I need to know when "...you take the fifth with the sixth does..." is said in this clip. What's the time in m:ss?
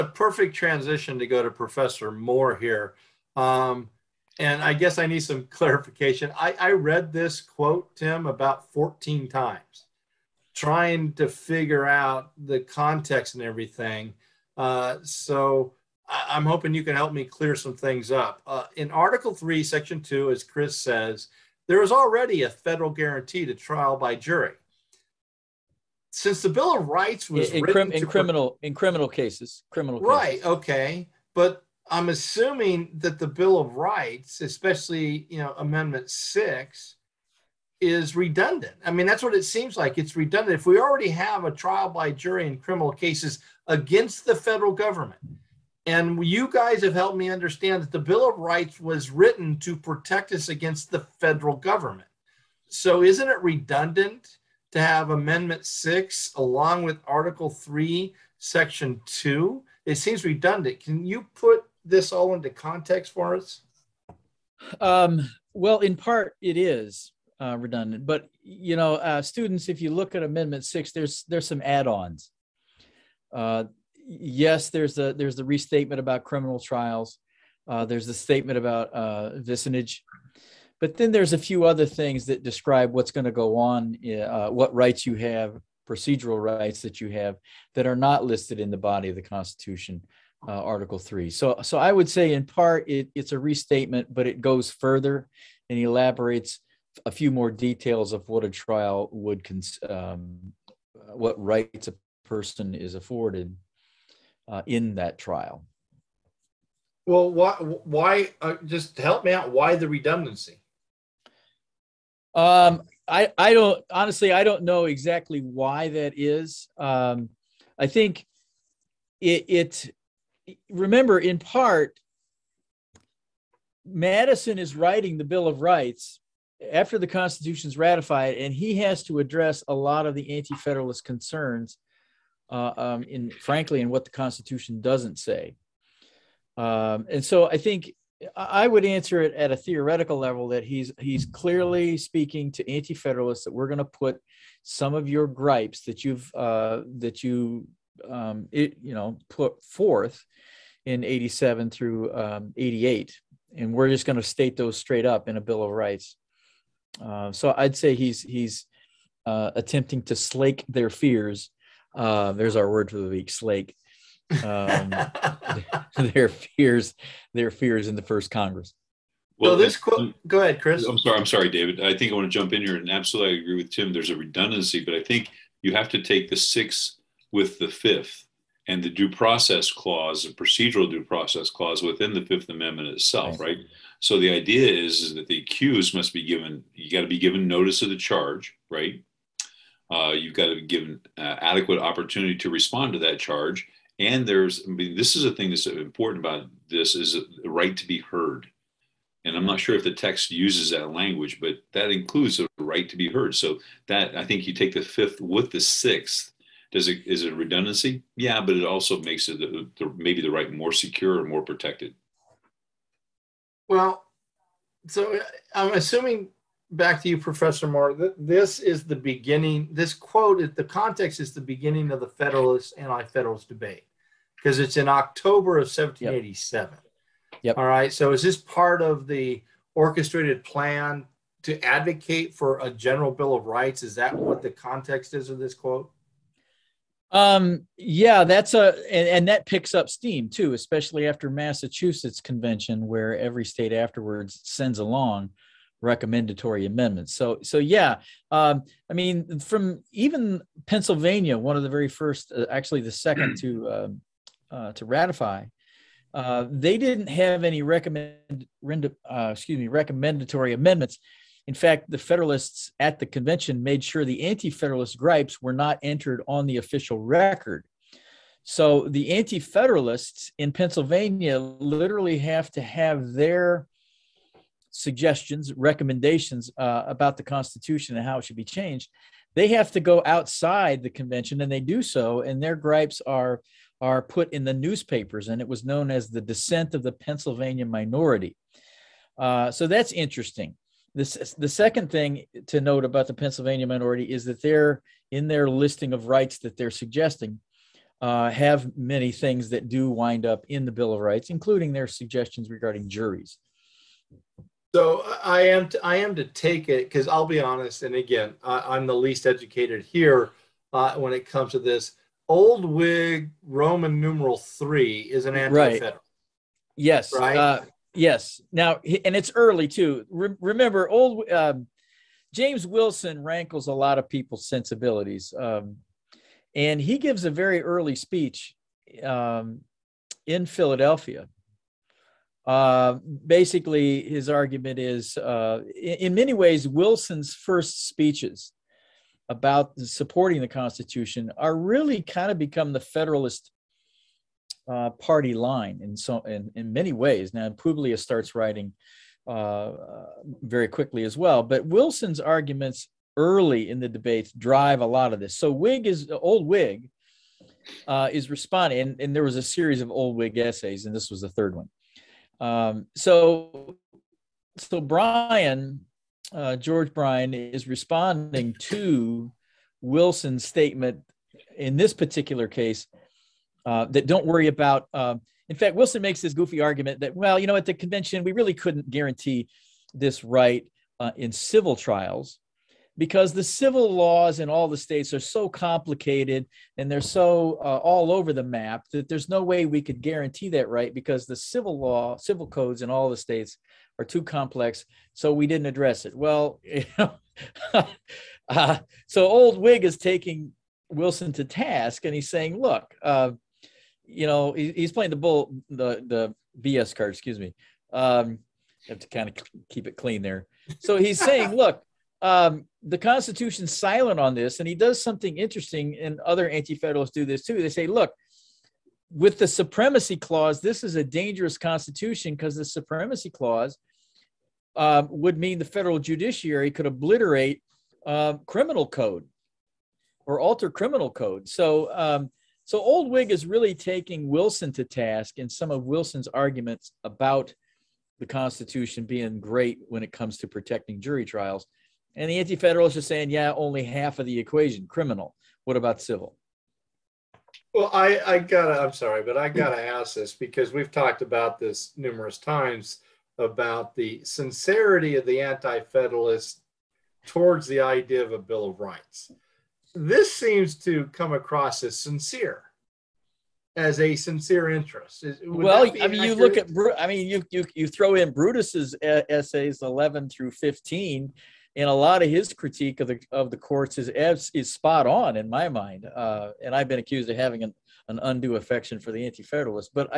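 3:24.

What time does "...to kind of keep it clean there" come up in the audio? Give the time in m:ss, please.
6:49.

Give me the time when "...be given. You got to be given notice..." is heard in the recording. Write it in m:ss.
3:06.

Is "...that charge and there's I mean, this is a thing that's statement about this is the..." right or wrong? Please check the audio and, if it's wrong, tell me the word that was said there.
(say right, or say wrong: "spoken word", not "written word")
wrong: "important", not "statement".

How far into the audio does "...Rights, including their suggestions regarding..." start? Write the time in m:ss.
5:01.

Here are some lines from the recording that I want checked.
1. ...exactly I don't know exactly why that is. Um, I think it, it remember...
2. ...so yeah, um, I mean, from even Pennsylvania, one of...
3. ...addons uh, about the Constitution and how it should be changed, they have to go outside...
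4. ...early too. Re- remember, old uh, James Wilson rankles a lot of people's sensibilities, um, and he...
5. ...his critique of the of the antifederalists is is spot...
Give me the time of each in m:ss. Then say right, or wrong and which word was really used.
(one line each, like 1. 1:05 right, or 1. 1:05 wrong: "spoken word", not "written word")
1. 1:53 wrong: "honestly", not "exactly"
2. 4:07 right
3. 4:35 wrong: "recommendations", not "addons"
4. 5:19 right
5. 7:52 wrong: "courts", not "antifederalists".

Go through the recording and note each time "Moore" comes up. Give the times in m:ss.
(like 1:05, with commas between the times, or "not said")
0:02, 3:37.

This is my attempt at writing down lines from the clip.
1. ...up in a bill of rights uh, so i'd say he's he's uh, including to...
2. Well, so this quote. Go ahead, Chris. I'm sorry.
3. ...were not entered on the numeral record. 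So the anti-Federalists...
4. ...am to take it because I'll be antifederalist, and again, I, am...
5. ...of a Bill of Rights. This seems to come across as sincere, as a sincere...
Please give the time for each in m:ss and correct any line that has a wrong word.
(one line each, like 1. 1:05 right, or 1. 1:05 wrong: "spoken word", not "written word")
1. 2:35 wrong: "attempting", not "including"
2. 2:49 right
3. 4:25 wrong: "official", not "numeral"
4. 5:05 wrong: "honest", not "antifederalist"
5. 7:38 right.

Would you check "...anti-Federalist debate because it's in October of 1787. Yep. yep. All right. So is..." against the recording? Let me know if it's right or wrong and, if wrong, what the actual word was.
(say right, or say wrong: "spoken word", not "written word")
right.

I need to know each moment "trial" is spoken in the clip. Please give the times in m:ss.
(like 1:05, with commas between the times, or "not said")
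0:23, 0:41, 1:16, 1:38, 1:45, 6:21, 7:21.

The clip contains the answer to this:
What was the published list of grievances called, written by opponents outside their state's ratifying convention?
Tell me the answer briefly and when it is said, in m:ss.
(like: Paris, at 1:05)
the dissent of the Pennsylvania minority, at 4:46.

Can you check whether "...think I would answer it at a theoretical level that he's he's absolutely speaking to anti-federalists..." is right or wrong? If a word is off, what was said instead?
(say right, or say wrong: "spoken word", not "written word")
wrong: "clearly", not "absolutely".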